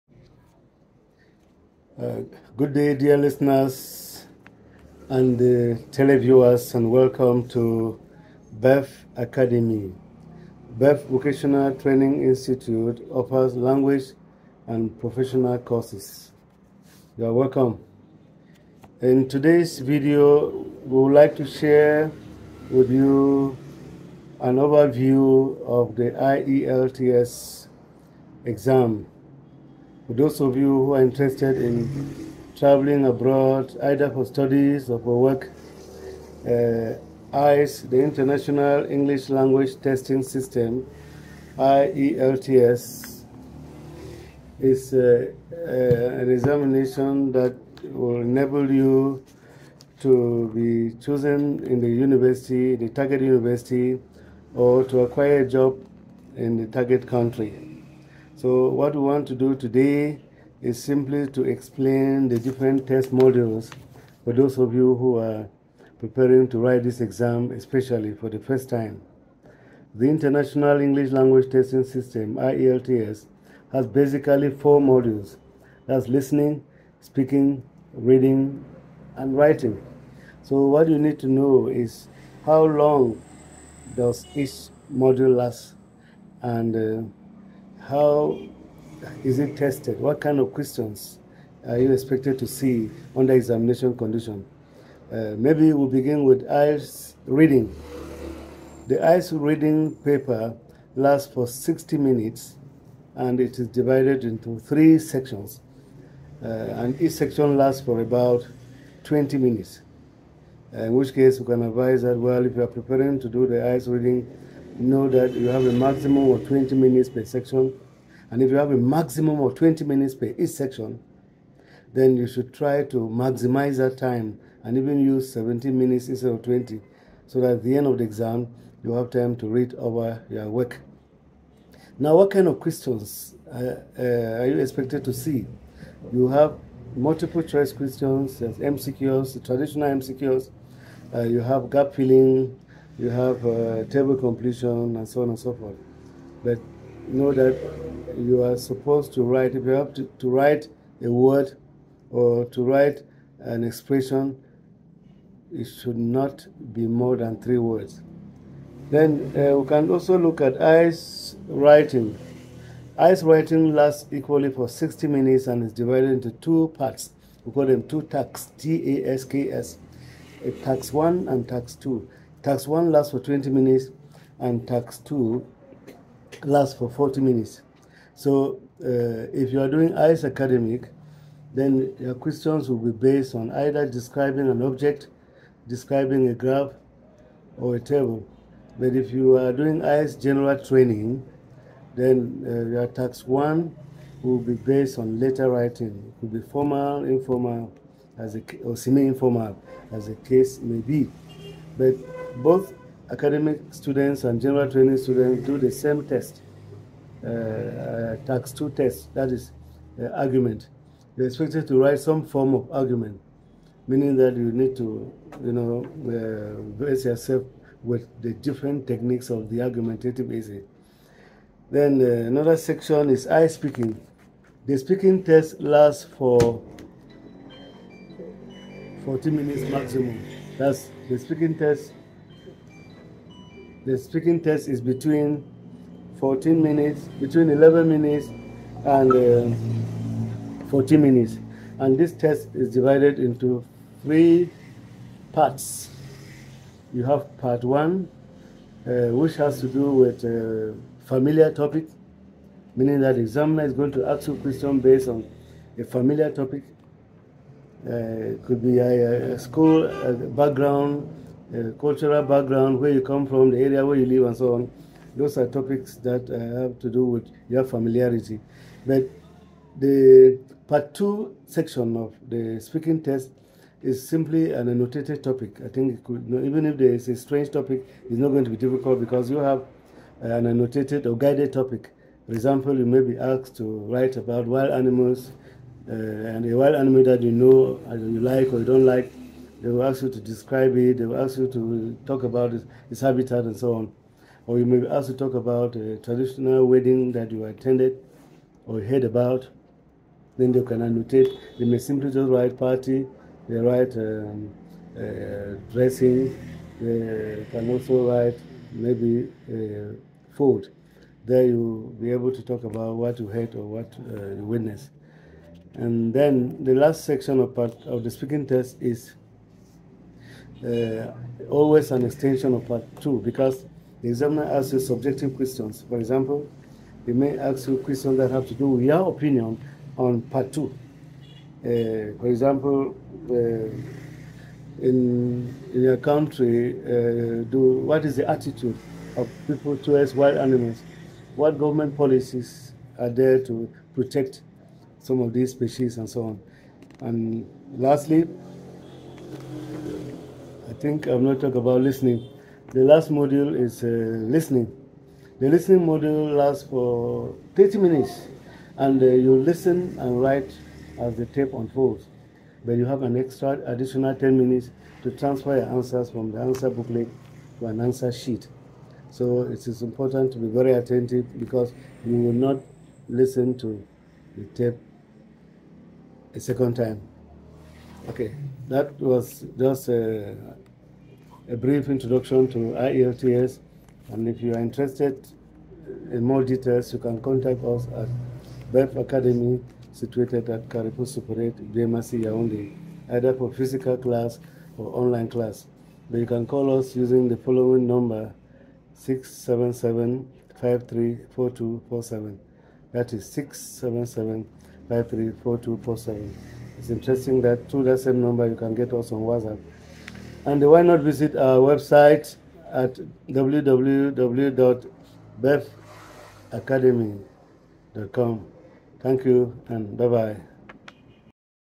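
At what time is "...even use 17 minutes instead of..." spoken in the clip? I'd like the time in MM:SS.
02:04.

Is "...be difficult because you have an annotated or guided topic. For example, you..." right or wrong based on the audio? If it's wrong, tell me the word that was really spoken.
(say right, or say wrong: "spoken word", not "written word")
right.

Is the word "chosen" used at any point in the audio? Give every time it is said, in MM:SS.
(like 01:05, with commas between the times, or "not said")
00:51.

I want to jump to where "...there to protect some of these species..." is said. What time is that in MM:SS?
05:43.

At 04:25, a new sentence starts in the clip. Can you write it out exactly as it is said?
Those are topics that uh, have to do with your familiarity.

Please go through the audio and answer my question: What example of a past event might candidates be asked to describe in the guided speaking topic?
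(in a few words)
A traditional wedding.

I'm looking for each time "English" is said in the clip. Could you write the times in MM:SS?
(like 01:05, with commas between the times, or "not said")
00:38, 01:10.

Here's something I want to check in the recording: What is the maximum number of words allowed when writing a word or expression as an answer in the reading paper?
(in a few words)
3.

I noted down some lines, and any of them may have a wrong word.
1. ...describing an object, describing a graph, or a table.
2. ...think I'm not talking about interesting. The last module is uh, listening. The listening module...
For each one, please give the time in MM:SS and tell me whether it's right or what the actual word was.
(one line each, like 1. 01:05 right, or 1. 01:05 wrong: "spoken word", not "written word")
1. 03:03 right
2. 05:50 wrong: "listening", not "interesting".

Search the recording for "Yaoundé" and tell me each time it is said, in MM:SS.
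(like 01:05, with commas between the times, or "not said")
06:32.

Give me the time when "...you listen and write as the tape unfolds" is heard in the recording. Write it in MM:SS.
05:59.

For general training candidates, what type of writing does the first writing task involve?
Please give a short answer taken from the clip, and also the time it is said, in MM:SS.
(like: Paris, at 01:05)
Letter writing, at 03:15.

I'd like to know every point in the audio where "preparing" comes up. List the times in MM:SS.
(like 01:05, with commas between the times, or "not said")
01:05, 01:52.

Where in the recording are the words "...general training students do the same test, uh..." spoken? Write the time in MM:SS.
03:24.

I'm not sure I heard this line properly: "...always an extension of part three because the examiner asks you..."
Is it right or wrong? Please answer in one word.
wrong.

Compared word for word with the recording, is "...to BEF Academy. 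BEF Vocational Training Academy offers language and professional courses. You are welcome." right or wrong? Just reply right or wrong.
wrong.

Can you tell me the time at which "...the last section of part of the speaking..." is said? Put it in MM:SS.
05:16.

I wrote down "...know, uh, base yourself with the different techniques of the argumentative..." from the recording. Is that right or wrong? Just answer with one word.
right.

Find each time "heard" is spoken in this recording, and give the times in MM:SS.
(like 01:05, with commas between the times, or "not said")
04:58, 05:13.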